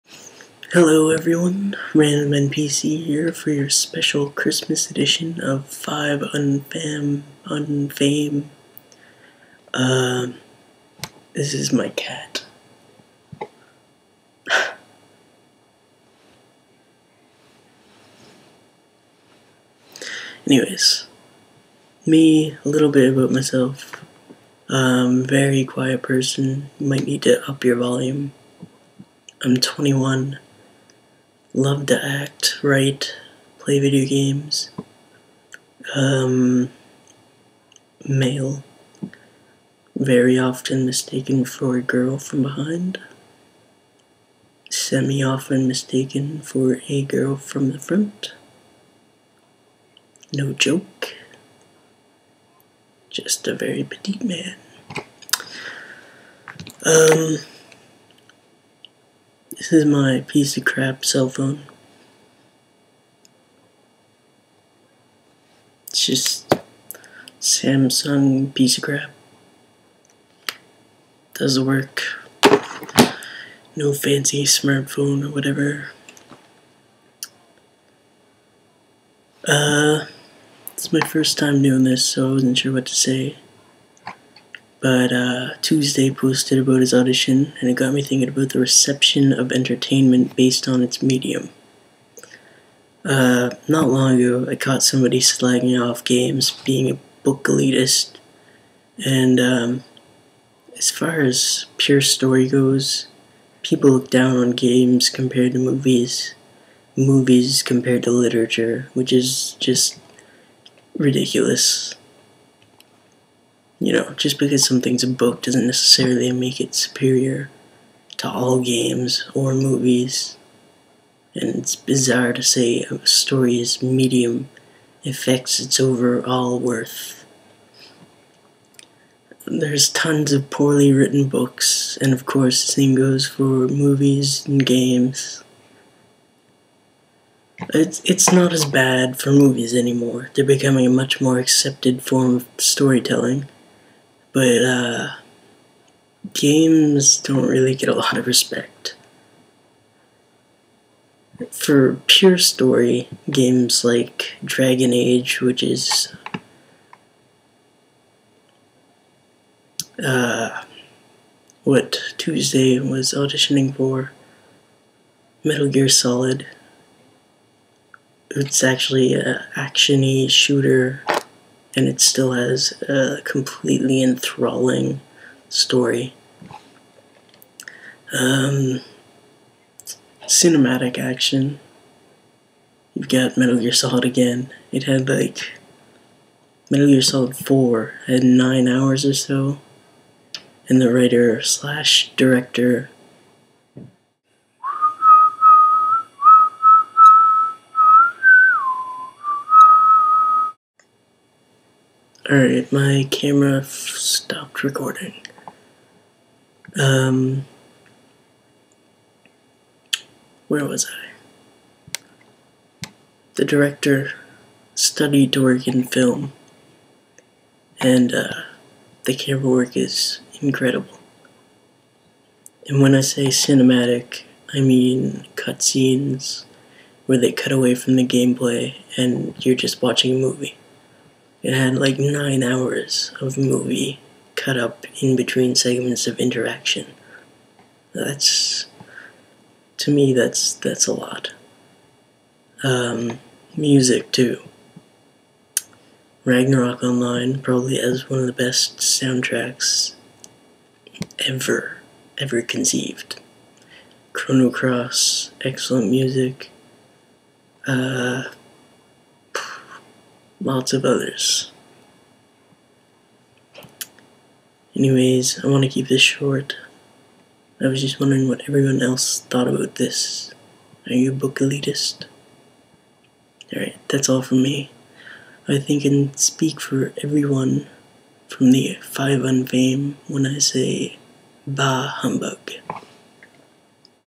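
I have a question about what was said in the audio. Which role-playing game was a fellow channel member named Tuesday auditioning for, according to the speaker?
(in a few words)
Dragon Age.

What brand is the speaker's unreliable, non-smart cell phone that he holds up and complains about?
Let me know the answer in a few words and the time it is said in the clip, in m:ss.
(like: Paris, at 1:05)
Samsung, at 1:07.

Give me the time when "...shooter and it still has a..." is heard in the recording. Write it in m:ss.
2:50.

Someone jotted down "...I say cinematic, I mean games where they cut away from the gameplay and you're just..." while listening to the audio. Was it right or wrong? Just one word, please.
wrong.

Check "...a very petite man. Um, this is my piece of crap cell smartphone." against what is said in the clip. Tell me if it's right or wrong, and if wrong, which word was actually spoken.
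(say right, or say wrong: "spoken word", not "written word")
wrong: "phone", not "smartphone".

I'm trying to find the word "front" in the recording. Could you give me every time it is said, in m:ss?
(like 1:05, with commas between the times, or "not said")
0:47.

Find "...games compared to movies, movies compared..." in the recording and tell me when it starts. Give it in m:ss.
1:44.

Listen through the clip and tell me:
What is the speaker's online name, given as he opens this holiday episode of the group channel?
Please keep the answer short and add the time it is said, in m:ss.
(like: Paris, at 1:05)
Random NPC, at 0:01.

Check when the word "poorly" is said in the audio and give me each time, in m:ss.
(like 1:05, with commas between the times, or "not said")
2:10.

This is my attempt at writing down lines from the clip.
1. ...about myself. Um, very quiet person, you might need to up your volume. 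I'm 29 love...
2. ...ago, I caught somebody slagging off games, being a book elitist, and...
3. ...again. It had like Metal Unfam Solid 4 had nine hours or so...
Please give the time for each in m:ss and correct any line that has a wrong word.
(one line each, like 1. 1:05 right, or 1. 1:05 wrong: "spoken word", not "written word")
1. 0:23 wrong: "21", not "29"
2. 1:34 right
3. 3:04 wrong: "Gear", not "Unfam".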